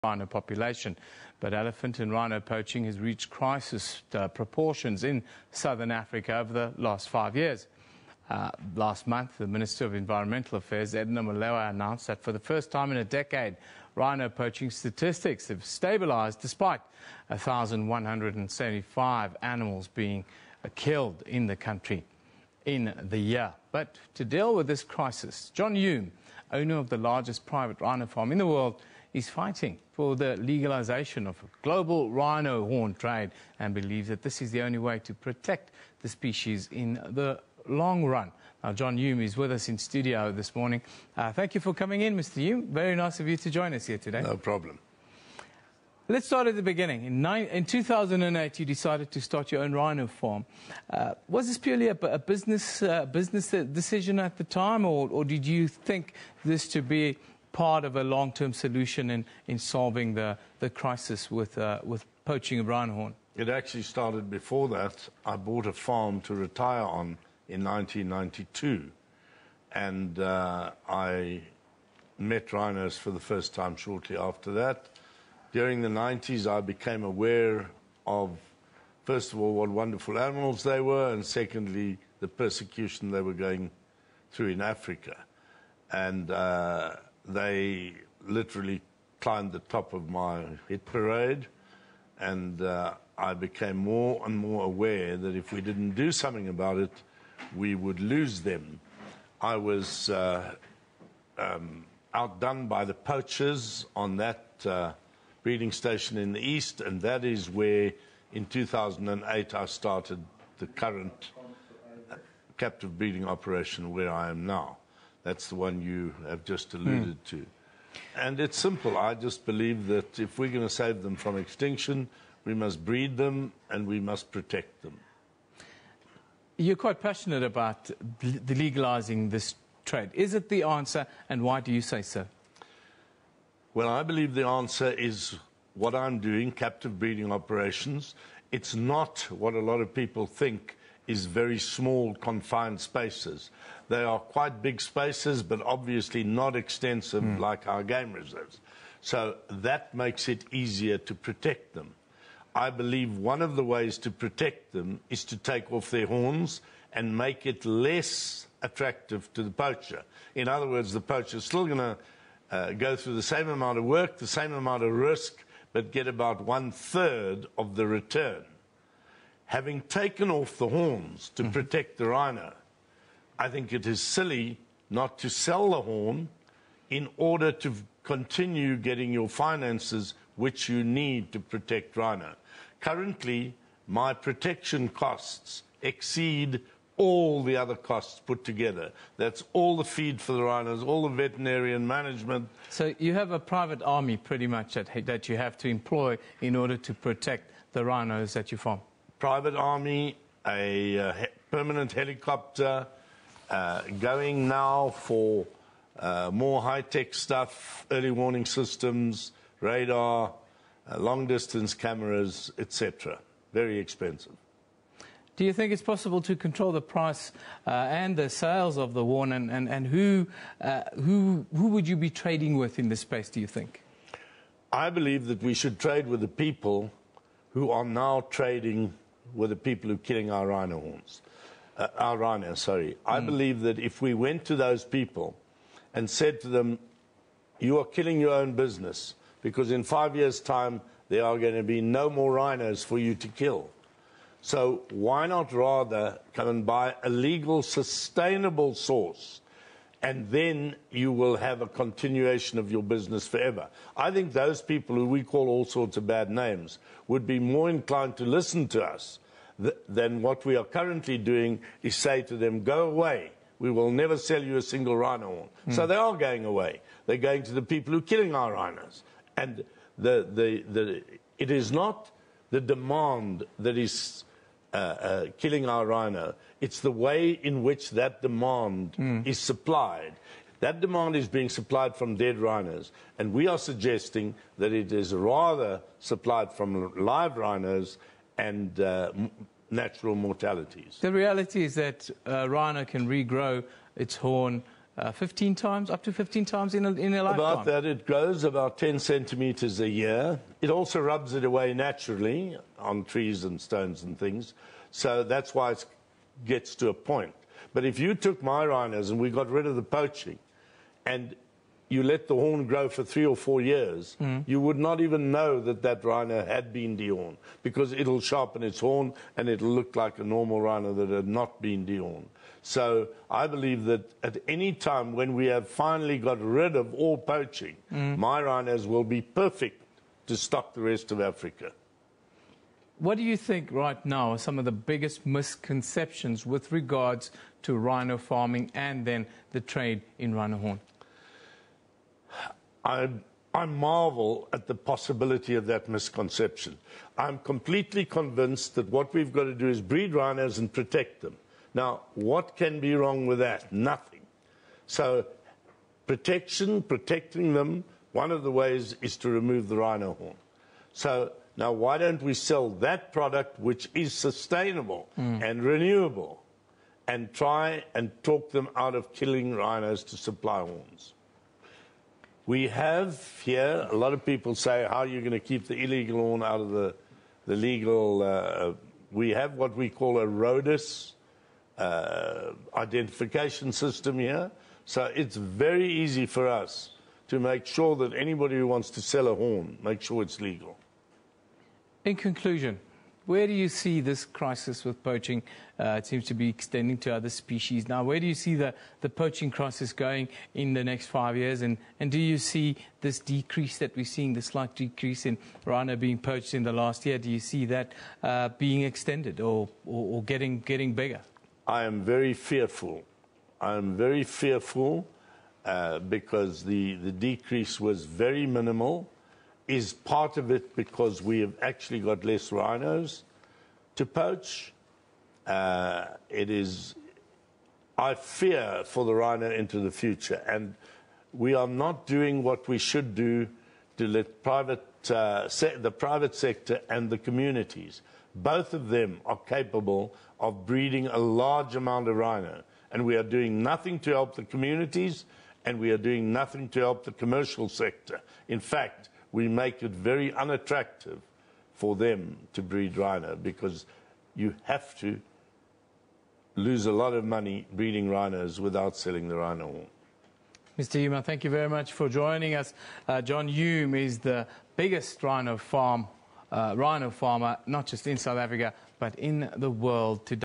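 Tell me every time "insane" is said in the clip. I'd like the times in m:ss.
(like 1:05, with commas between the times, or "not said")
not said.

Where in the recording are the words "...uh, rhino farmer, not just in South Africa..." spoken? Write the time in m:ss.
7:46.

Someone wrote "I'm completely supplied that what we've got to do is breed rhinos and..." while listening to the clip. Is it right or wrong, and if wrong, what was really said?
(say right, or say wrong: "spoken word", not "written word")
wrong: "convinced", not "supplied".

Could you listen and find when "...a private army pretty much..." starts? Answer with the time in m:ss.
3:13.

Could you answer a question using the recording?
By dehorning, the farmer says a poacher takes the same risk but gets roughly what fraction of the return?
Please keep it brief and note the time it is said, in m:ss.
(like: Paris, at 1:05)
One third, at 2:46.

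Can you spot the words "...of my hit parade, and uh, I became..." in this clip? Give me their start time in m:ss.
1:29.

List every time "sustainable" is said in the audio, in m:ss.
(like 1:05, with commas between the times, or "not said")
4:07, 6:04.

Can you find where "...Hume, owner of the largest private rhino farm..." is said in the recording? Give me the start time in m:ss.
0:25.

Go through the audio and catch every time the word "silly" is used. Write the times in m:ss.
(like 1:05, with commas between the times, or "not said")
2:54.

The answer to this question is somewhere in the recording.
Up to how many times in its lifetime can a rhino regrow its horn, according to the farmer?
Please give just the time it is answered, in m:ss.
4:55.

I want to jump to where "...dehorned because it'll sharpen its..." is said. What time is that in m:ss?
5:16.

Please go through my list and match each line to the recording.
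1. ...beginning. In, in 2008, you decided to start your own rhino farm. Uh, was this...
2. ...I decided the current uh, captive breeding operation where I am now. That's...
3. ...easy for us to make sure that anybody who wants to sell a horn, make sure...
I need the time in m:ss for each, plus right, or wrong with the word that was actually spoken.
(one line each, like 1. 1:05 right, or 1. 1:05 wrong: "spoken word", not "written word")
1. 0:46 right
2. 1:49 wrong: "started", not "decided"
3. 6:25 right.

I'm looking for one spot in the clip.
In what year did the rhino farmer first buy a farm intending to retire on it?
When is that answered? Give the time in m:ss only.
1:07.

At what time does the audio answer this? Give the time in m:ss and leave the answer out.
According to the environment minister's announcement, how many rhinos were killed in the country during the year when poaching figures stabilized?
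0:17.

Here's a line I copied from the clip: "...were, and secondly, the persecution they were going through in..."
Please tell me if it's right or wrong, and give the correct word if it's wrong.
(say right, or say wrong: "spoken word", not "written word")
right.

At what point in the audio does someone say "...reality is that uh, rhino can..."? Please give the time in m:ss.
4:51.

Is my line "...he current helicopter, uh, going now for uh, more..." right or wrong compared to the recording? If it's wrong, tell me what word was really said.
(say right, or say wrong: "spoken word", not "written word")
wrong: "permanent", not "current".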